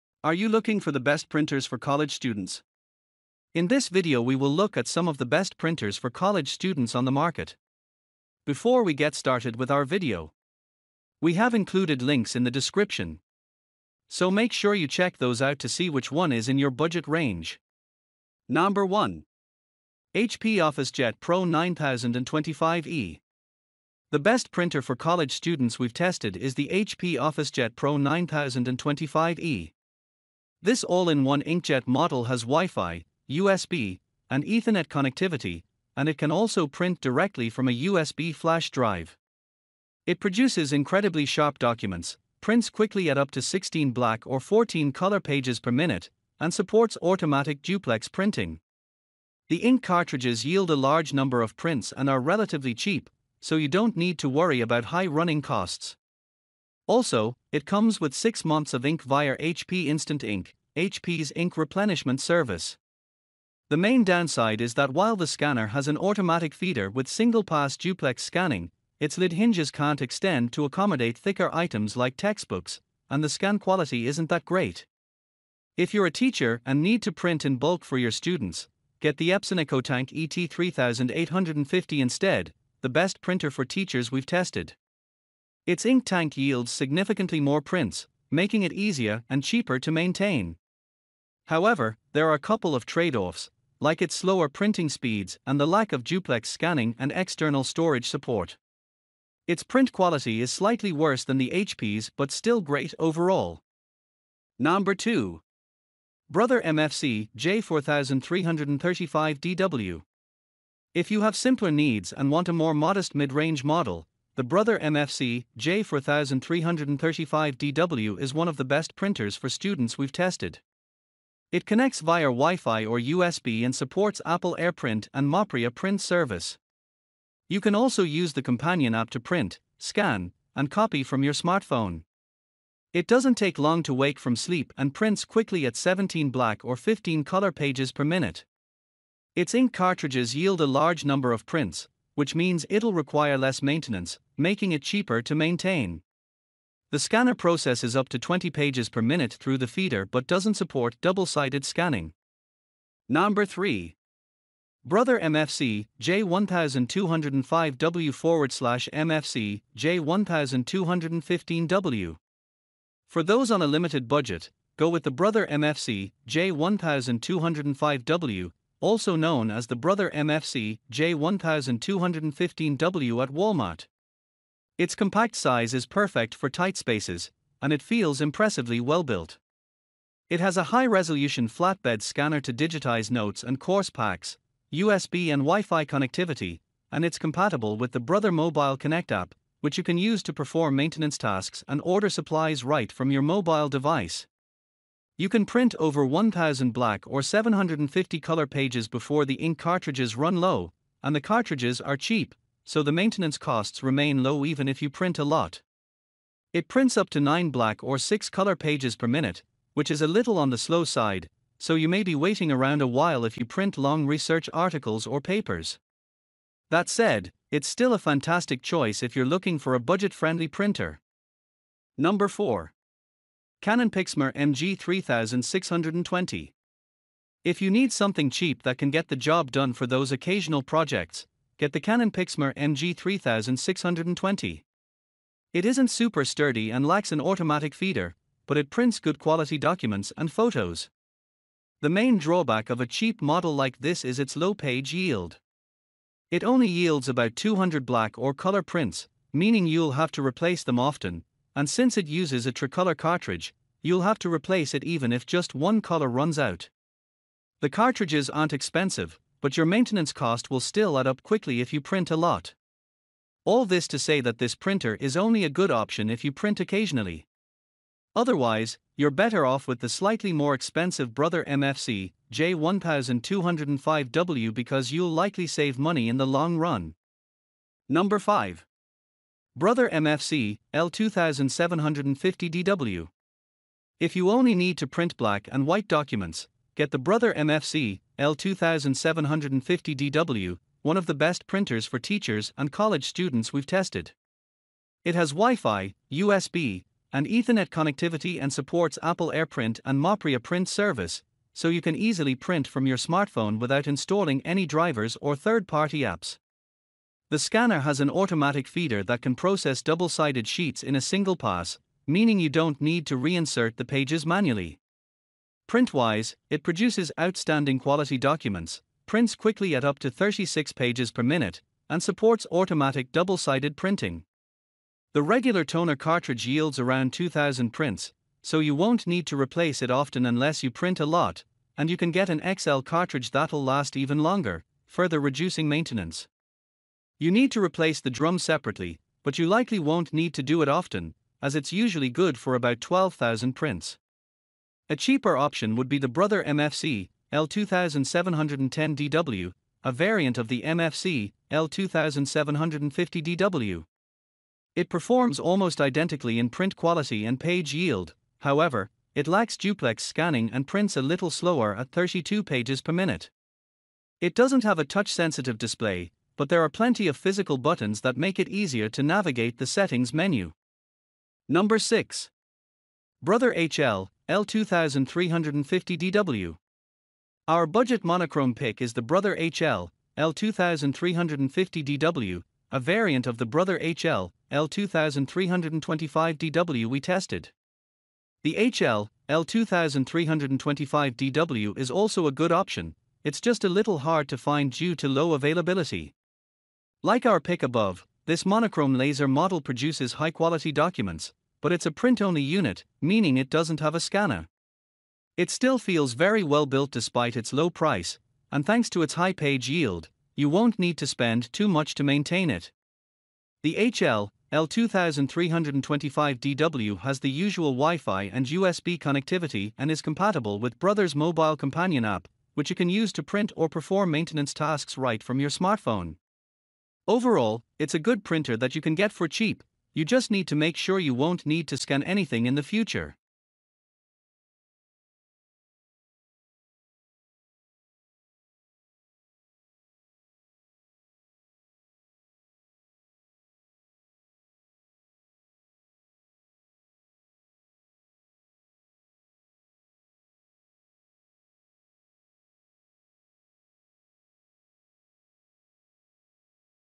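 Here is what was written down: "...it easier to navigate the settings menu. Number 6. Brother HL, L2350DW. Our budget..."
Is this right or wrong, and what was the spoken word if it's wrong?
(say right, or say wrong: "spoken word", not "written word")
right.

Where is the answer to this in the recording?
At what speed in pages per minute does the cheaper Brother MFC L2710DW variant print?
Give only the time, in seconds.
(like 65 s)
361 s.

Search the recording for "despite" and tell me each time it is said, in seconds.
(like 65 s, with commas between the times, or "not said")
406 s.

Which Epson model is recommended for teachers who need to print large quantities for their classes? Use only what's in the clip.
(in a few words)
Epson EcoTank ET3850.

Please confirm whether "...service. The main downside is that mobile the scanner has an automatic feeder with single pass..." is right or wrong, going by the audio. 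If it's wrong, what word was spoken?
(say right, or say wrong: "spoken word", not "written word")
wrong: "while", not "mobile".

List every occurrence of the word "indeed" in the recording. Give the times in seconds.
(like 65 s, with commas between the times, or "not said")
not said.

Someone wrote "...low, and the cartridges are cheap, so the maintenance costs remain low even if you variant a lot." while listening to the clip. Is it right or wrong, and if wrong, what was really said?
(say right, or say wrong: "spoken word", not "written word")
wrong: "print", not "variant".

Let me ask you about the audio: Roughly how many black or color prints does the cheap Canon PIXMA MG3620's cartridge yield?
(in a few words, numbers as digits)
200.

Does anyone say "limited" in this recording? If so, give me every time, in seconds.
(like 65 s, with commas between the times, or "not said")
163 s.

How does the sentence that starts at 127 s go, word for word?
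You can also use the companion app to print, scan, and copy from your smartphone.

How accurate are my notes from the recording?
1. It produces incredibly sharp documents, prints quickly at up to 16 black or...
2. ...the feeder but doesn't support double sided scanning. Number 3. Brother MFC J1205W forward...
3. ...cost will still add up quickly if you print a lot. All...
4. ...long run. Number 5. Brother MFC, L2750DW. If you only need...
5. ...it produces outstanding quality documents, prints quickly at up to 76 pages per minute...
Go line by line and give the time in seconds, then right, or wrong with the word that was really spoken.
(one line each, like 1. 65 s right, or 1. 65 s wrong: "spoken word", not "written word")
1. 40 s right
2. 149 s right
3. 260 s right
4. 276 s right
5. 316 s wrong: "36", not "76".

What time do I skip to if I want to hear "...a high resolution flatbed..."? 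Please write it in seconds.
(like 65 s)
180 s.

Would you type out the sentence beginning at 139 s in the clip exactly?
Its ink cartridges yield a large number of prints, which means it'll require less maintenance, making it cheaper to maintain.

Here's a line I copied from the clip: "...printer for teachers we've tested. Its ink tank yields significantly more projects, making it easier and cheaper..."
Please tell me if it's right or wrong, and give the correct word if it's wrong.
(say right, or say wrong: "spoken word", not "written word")
wrong: "prints", not "projects".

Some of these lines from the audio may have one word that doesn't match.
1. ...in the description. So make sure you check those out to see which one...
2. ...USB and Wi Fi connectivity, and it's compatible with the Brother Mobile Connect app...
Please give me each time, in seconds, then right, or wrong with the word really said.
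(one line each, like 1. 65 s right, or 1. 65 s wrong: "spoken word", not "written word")
1. 12 s right
2. 184 s right.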